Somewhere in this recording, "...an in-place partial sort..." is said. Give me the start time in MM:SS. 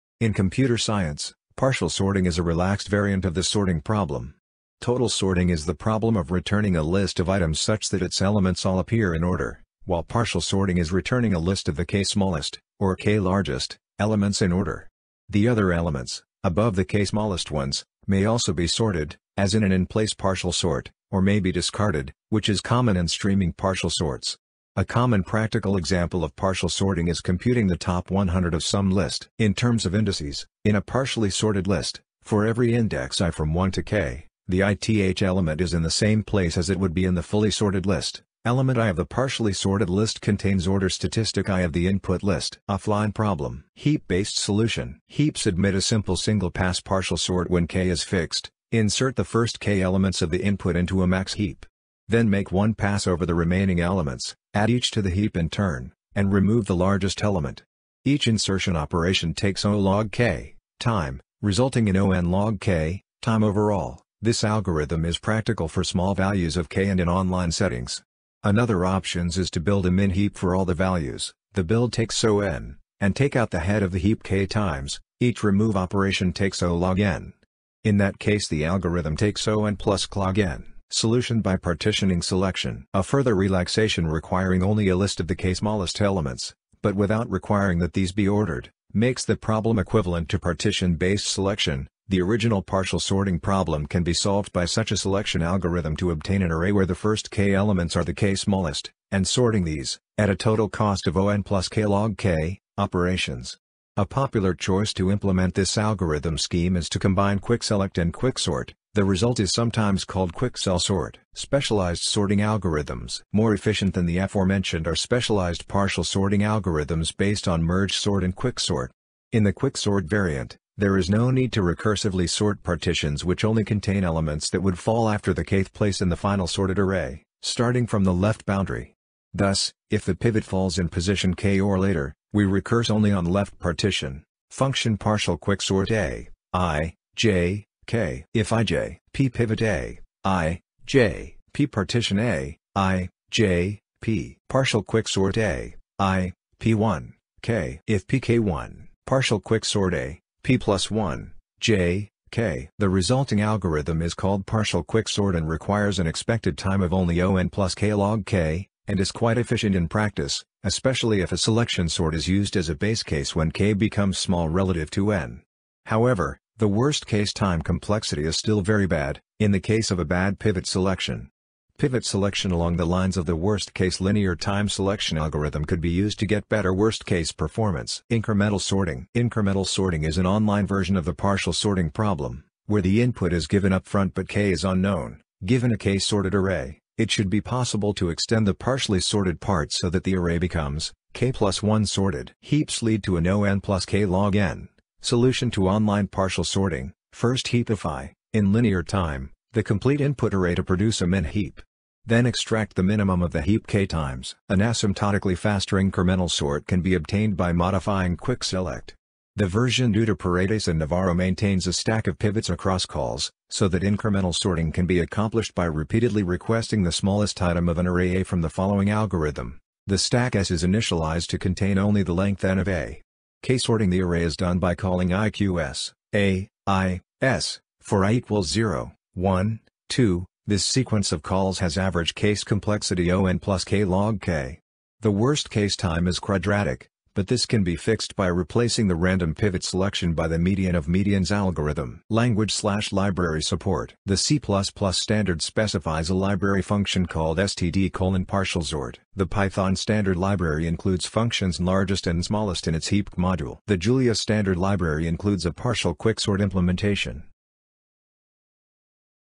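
00:19.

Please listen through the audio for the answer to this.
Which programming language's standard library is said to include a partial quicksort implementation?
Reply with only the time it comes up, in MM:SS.
04:13.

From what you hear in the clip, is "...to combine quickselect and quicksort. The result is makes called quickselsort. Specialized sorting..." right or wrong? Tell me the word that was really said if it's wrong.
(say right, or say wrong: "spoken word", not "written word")
wrong: "sometimes", not "makes".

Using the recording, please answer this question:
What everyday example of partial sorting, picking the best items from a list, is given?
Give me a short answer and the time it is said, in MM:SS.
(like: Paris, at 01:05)
top 100, at 00:27.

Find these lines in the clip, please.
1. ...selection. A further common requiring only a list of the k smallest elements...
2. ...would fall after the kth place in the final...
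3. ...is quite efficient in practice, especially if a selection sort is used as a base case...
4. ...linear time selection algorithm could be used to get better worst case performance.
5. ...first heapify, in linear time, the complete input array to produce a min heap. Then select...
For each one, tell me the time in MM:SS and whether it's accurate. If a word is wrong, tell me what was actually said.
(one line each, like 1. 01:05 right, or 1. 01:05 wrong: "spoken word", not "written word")
1. 01:22 wrong: "relaxation", not "common"
2. 02:04 right
3. 02:39 right
4. 02:53 right
5. 03:17 wrong: "extract", not "select".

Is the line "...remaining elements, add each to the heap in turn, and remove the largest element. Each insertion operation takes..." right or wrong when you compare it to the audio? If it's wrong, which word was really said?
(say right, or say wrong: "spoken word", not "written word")
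right.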